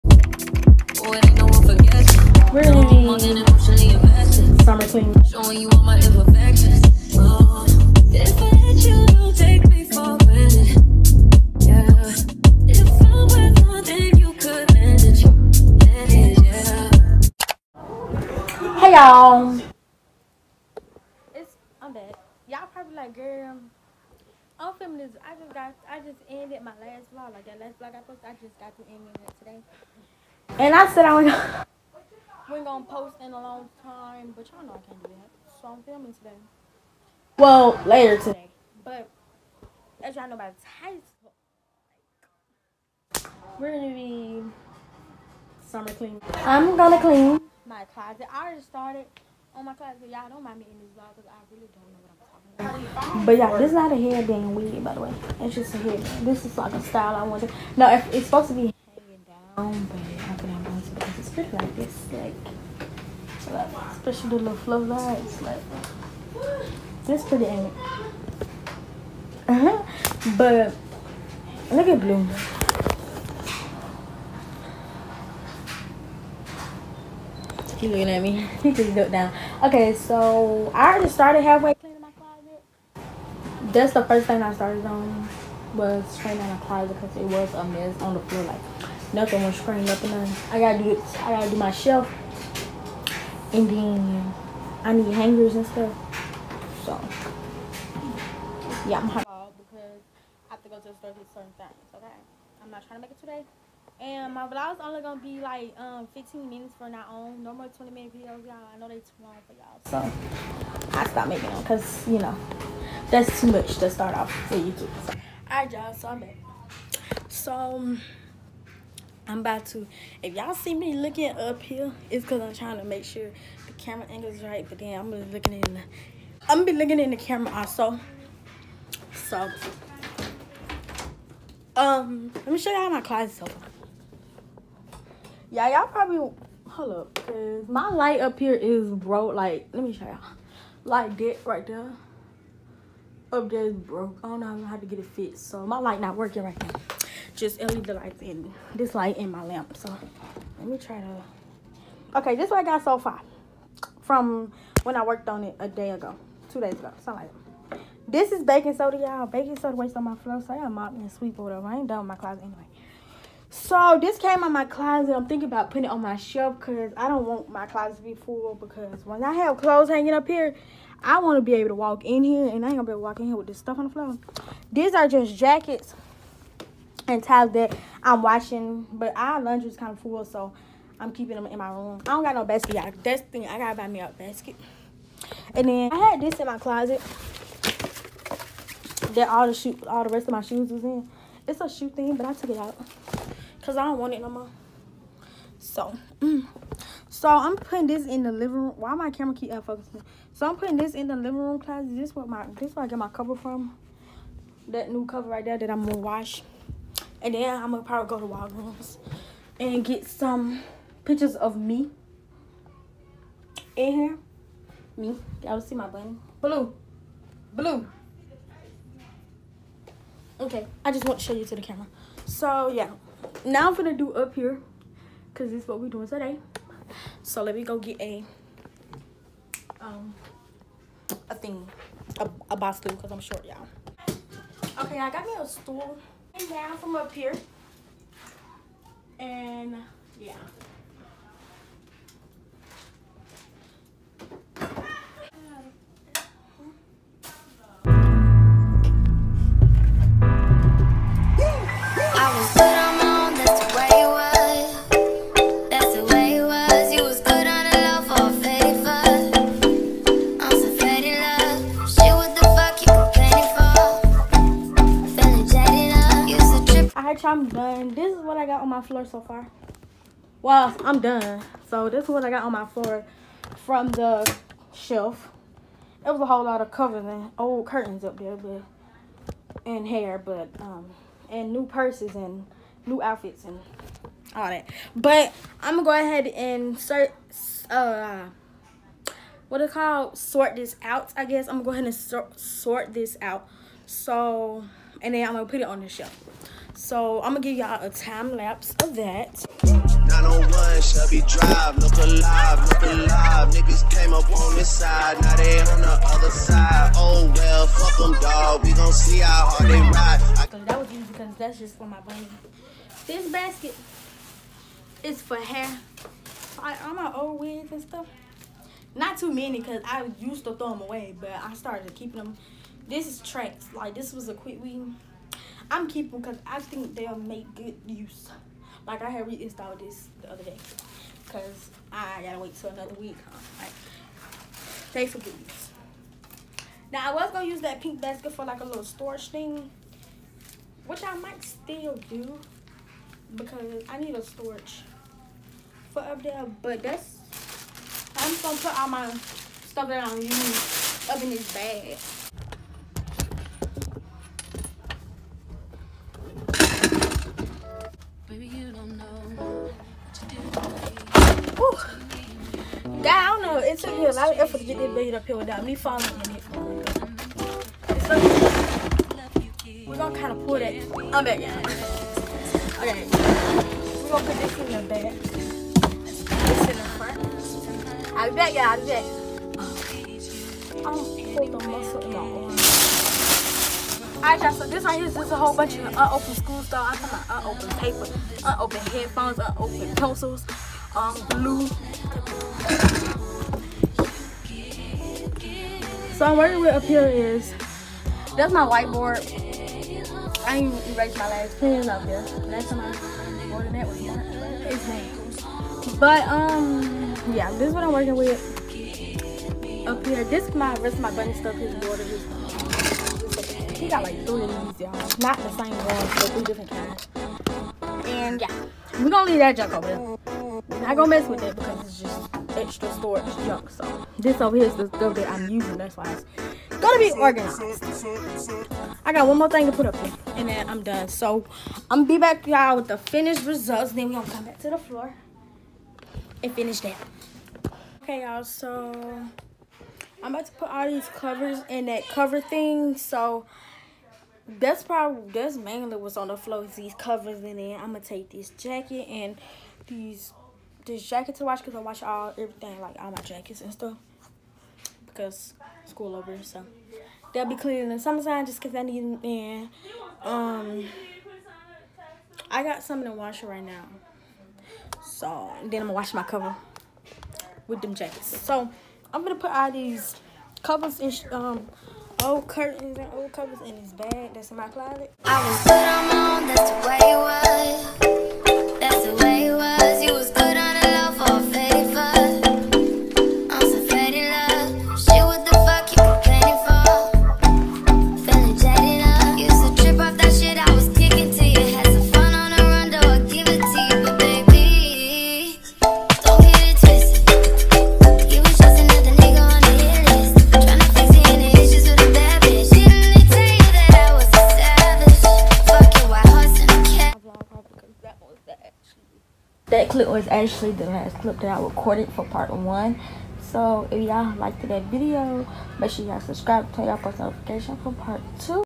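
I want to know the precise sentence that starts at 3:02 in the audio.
I don't got no basket, y'all.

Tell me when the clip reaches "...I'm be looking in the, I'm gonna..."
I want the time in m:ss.
2:04.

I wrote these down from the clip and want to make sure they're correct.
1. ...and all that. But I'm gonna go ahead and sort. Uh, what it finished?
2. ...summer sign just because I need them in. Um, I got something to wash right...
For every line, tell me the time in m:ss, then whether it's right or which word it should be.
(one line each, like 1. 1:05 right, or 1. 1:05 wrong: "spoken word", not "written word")
1. 4:43 wrong: "called", not "finished"
2. 7:37 right.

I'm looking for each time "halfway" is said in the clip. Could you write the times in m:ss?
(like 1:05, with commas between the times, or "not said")
1:21.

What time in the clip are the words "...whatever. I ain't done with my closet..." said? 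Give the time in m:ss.
2:41.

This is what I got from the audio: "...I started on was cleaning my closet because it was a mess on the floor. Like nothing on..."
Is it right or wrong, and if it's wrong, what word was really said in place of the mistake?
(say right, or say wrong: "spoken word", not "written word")
right.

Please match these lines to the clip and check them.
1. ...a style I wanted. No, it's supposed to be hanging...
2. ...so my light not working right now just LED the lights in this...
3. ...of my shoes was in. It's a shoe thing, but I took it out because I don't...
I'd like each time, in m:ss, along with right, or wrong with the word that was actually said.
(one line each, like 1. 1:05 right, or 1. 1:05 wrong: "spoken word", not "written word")
1. 0:56 right
2. 2:25 right
3. 3:10 right.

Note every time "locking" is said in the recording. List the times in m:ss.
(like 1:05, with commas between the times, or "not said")
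not said.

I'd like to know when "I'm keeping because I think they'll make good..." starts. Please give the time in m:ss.
5:25.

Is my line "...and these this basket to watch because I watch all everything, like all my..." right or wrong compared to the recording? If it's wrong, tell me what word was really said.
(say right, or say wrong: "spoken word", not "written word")
wrong: "jacket", not "basket".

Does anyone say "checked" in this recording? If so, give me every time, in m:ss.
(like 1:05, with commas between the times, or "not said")
not said.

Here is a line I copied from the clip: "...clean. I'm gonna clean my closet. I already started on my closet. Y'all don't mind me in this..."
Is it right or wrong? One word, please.
right.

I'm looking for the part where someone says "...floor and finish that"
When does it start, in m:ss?
7:14.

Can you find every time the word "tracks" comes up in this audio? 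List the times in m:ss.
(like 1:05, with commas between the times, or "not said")
5:23.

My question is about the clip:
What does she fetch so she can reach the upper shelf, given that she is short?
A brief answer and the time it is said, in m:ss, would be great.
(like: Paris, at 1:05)
A bar stool, at 3:52.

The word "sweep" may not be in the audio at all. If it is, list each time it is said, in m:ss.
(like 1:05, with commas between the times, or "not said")
2:41.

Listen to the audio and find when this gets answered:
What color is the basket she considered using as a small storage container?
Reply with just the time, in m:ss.
5:37.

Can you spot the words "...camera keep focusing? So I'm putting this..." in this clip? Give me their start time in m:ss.
3:19.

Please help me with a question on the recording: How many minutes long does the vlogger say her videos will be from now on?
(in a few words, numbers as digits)
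15.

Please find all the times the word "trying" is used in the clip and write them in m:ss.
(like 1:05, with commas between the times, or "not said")
1:42, 2:02.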